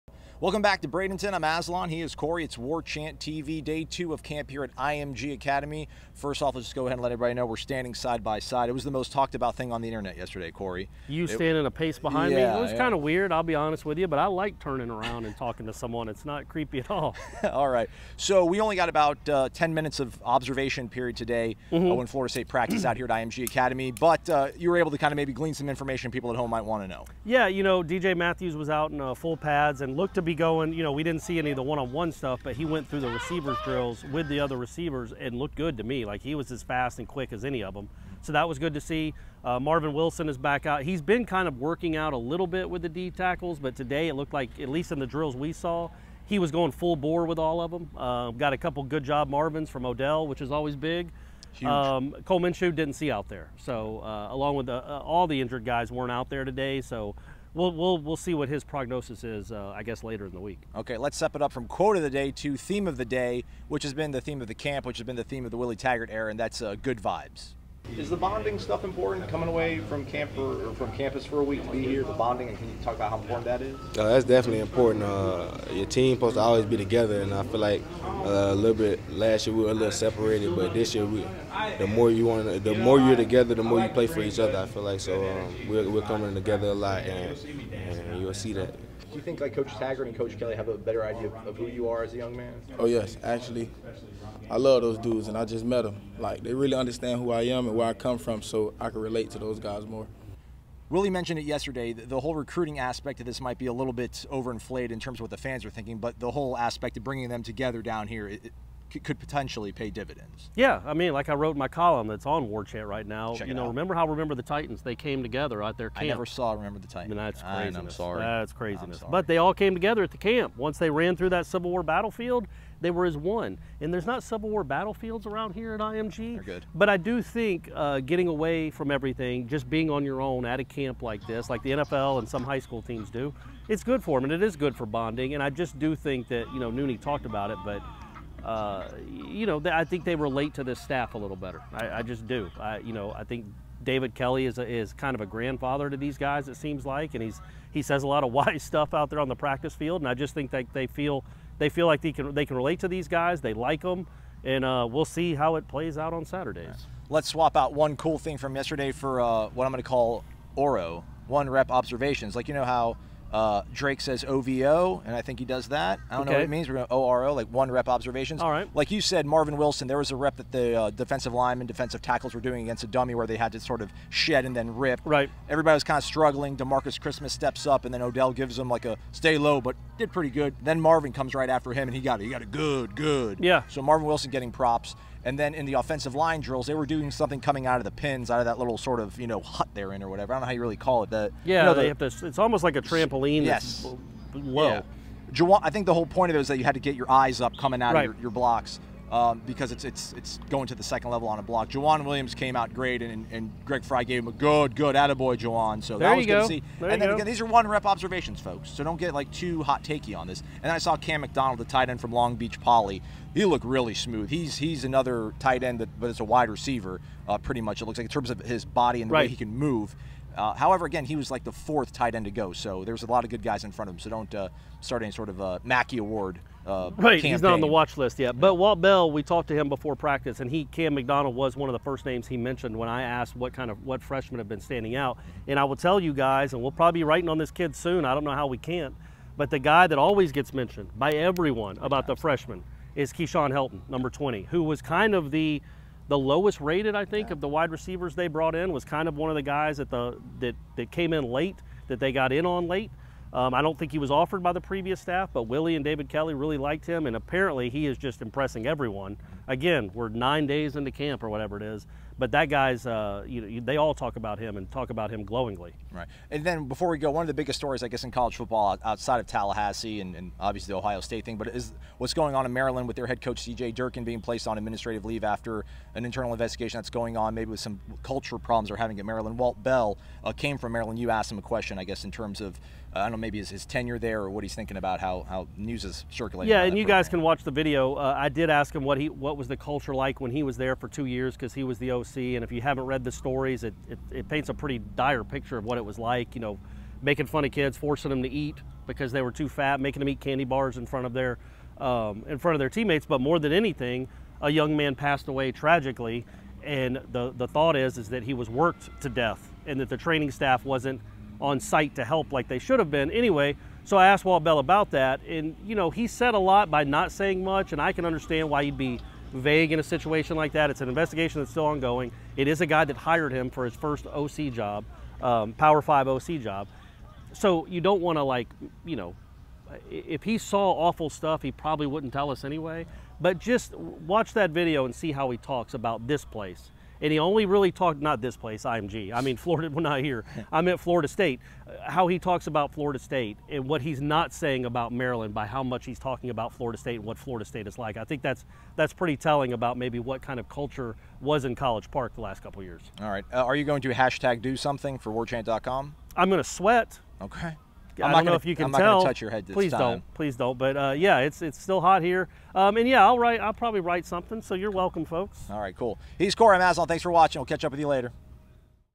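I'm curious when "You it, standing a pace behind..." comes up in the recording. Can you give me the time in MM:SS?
00:11.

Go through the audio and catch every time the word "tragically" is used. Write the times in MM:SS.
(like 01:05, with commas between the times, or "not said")
05:05.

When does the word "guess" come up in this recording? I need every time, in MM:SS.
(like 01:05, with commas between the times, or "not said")
00:59, 04:27, 04:41.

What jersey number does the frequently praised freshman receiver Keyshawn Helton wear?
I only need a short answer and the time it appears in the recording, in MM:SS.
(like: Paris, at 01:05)
20, at 04:04.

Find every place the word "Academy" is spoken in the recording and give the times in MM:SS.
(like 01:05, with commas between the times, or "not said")
00:05, 00:23.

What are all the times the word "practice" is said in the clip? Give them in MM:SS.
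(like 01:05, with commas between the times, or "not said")
00:22, 02:29, 03:49.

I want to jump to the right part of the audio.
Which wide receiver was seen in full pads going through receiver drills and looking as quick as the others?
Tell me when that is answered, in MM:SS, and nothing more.
00:27.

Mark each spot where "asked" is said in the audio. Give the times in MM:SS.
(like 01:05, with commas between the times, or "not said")
03:53, 04:41, 05:14.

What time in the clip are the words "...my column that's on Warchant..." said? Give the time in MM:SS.
01:51.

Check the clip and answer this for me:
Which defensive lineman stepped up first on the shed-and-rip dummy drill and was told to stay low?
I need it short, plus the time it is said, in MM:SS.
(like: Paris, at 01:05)
Demarcus Christmas, at 02:56.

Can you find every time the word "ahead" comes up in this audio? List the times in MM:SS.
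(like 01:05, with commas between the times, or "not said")
00:06.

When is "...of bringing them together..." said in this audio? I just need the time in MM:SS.
01:46.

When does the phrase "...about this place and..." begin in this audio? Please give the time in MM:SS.
05:35.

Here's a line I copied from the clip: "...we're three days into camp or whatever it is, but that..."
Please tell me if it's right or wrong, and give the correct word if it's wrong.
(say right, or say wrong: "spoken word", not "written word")
wrong: "nine", not "three".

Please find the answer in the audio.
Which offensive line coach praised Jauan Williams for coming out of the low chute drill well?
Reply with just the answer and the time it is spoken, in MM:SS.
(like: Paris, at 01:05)
Greg Frey, at 03:23.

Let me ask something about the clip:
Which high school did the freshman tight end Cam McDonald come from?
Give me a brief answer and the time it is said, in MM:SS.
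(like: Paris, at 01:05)
Long Beach Poly, at 03:32.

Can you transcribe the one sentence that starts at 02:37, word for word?
Let's swap out one cool thing from yesterday for uh, what I'm going to call Oro one rep observations.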